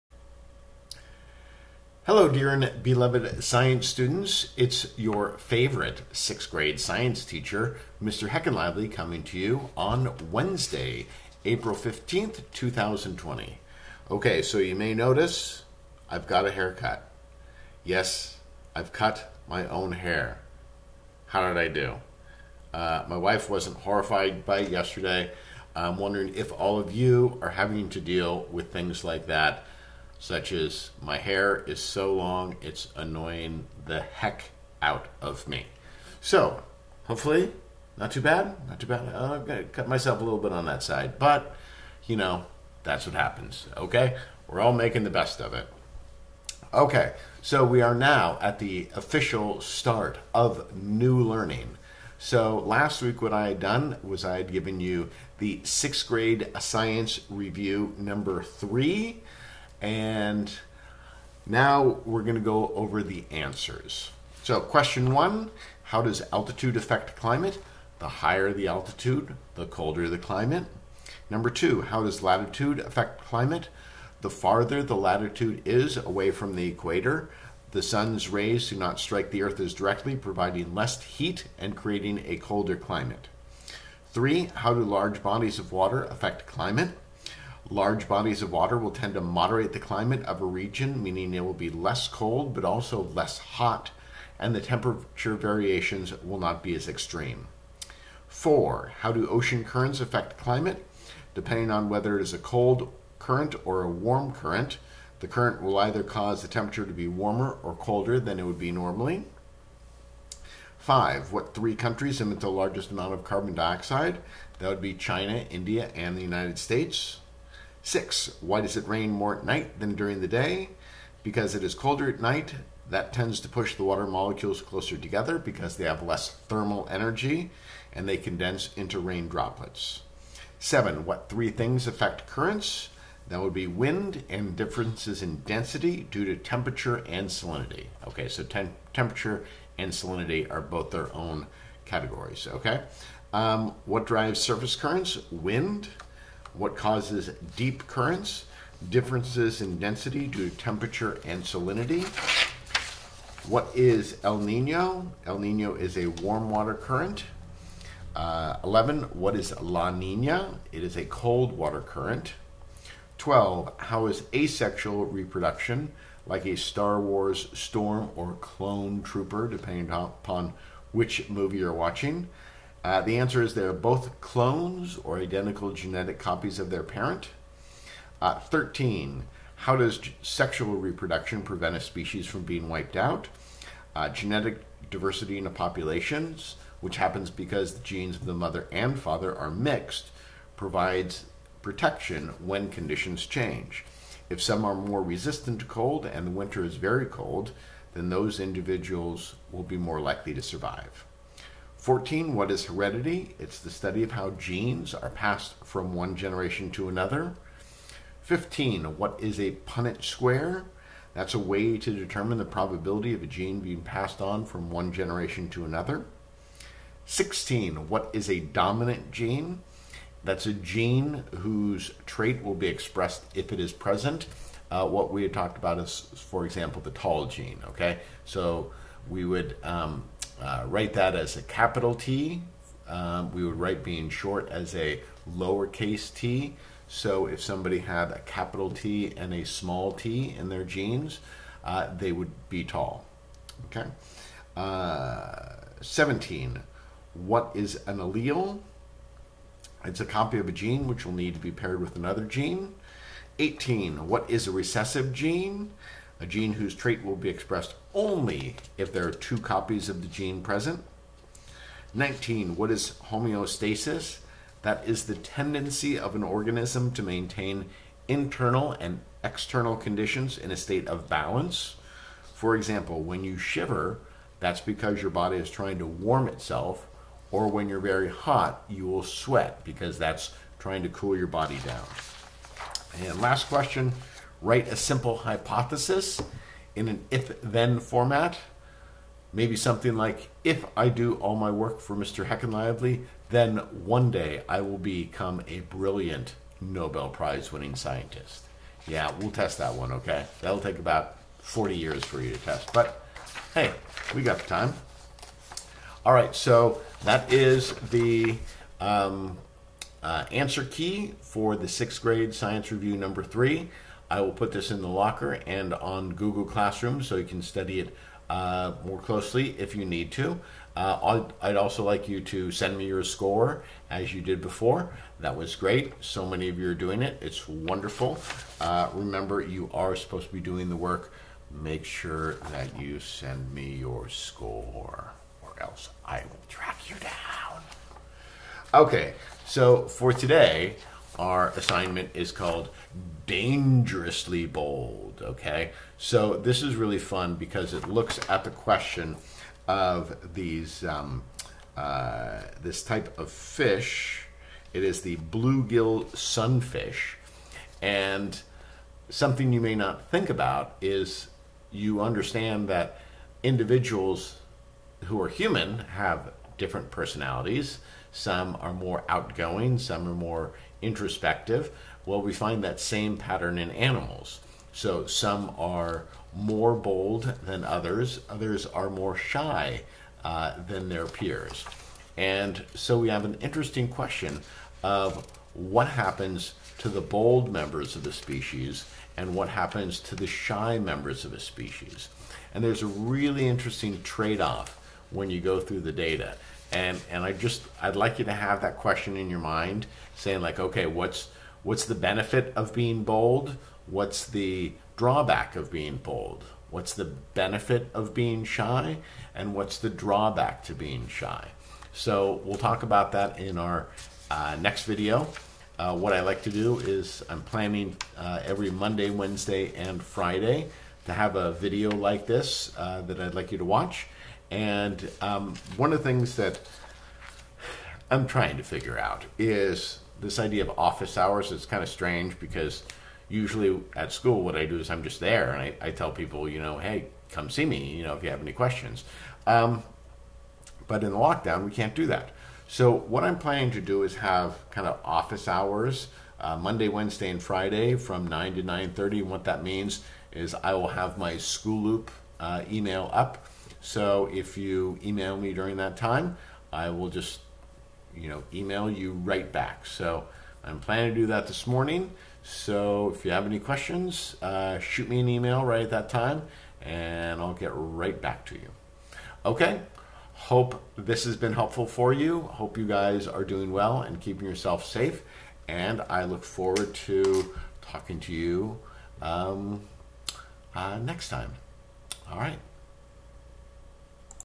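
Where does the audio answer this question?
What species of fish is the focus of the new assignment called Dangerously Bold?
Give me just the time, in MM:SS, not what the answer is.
05:55.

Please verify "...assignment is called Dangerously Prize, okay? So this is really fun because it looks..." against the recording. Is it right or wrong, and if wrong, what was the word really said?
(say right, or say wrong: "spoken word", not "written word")
wrong: "Bold", not "Prize".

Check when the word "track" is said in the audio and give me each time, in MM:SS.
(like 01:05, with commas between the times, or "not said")
05:36.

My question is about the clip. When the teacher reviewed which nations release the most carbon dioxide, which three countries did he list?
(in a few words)
China, India, and the United States.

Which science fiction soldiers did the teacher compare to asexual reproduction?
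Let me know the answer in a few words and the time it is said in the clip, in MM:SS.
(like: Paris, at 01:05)
Storm or clone trooper, at 02:46.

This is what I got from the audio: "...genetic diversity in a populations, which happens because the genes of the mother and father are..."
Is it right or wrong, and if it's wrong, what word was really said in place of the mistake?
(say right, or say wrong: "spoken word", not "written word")
right.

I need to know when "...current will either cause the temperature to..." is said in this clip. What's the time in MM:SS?
01:45.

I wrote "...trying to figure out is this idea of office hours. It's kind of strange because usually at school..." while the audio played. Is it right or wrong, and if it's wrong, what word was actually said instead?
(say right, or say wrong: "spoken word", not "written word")
right.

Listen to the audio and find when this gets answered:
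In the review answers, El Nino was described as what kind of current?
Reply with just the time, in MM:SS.
02:36.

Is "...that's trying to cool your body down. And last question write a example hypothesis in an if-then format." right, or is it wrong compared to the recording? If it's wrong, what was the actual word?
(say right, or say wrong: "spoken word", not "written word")
wrong: "simple", not "example".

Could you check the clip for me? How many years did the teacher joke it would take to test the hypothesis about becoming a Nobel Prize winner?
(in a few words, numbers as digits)
40.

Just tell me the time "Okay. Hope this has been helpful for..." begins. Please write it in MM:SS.
07:49.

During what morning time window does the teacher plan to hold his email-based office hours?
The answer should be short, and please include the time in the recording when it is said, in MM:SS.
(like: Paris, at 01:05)
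9 to 9:30, at 07:28.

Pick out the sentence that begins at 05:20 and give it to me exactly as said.
Uh, I'd, I'd, also like you to send me your score as you did before.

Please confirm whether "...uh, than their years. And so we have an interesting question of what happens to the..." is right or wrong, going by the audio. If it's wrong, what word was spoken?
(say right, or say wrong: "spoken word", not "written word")
wrong: "peers", not "years".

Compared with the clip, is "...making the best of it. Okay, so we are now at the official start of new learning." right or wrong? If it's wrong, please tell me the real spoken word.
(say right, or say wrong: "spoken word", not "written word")
right.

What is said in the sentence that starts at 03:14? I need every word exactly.
If some are more resistant to cold and the winter is very cold, then those individuals will be more likely to survive.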